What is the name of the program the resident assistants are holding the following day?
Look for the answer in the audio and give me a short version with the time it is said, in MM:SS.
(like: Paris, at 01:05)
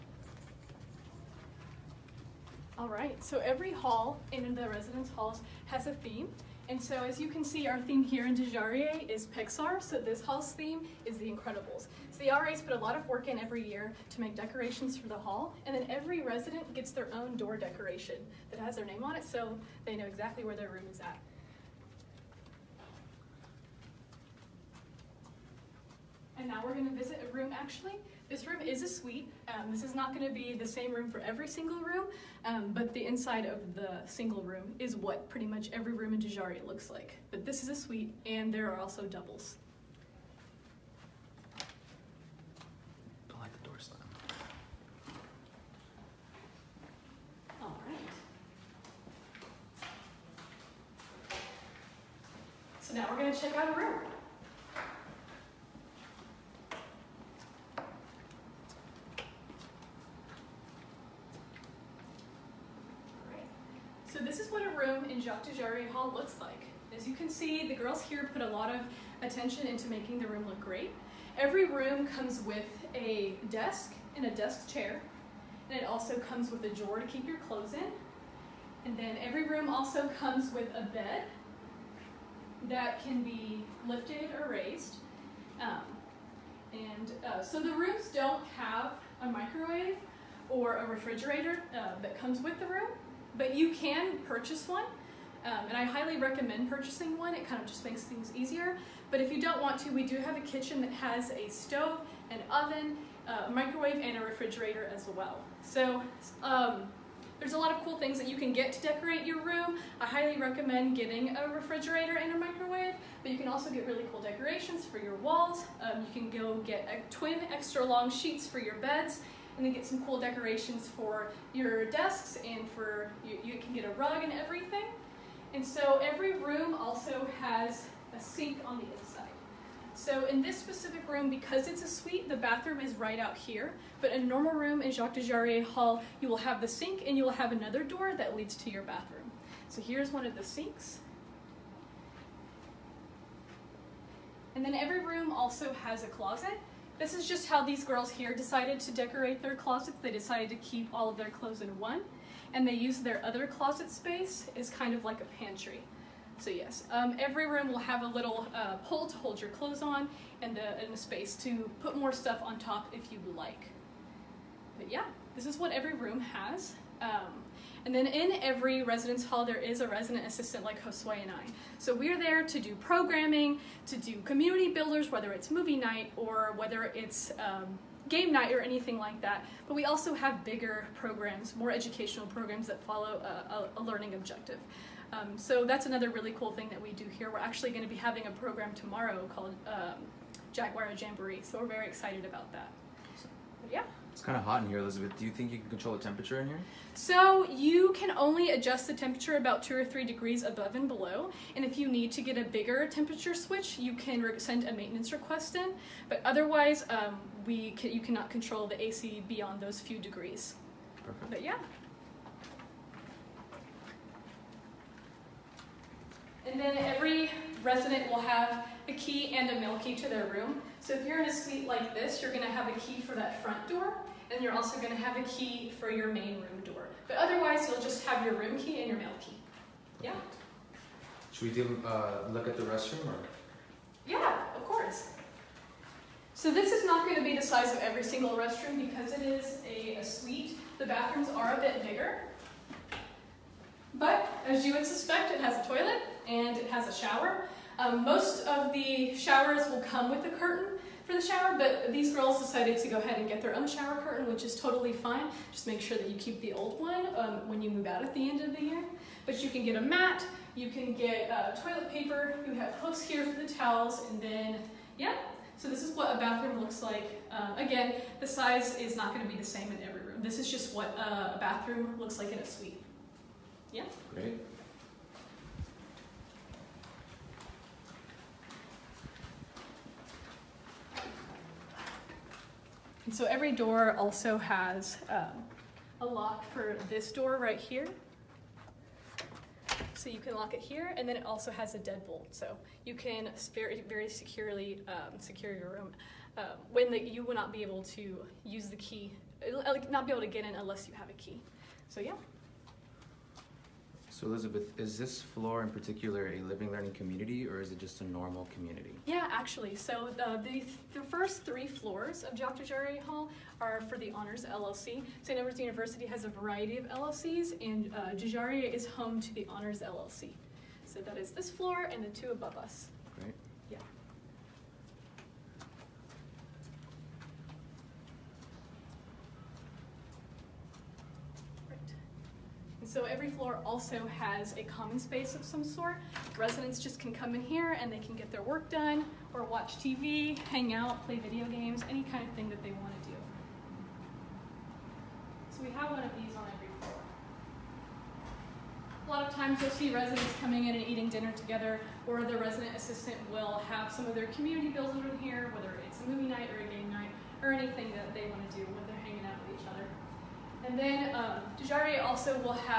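Jaguar Jamboree, at 03:10.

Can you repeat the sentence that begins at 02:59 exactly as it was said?
But we also have bigger programs, more educational programs that follow a, a, a learning objective.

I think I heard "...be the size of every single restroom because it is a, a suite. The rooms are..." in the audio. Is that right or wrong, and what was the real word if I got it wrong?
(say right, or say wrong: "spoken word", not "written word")
wrong: "bathrooms", not "rooms".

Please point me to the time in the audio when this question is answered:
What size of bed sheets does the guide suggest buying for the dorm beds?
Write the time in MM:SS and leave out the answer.
01:57.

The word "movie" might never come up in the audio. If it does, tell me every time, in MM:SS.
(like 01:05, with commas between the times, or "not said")
02:55, 05:56.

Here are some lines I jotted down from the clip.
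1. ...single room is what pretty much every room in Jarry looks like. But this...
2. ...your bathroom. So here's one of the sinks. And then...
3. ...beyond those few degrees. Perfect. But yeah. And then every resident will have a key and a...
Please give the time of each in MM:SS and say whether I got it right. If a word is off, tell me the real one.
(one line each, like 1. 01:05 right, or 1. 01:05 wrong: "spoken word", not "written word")
1. 00:34 wrong: "Dujarié", not "Jarry"
2. 02:18 right
3. 03:29 right.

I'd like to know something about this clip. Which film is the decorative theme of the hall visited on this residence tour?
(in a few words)
The Incredibles.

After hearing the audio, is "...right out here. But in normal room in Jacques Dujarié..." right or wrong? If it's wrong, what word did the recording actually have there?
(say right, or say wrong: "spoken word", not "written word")
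right.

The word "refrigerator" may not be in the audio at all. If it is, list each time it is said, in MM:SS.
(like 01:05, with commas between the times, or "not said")
01:30, 01:44, 01:51.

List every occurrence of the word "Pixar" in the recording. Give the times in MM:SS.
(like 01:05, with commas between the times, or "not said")
00:09.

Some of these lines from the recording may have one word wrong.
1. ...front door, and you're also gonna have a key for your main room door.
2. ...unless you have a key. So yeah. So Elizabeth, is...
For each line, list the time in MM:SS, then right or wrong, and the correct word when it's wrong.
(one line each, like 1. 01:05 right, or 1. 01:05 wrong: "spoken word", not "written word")
1. 03:43 right
2. 05:00 right.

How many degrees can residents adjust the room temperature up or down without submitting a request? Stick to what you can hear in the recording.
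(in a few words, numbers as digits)
2 or 3.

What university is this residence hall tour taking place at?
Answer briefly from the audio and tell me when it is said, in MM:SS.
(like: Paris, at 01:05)
St. Edward's University, at 05:15.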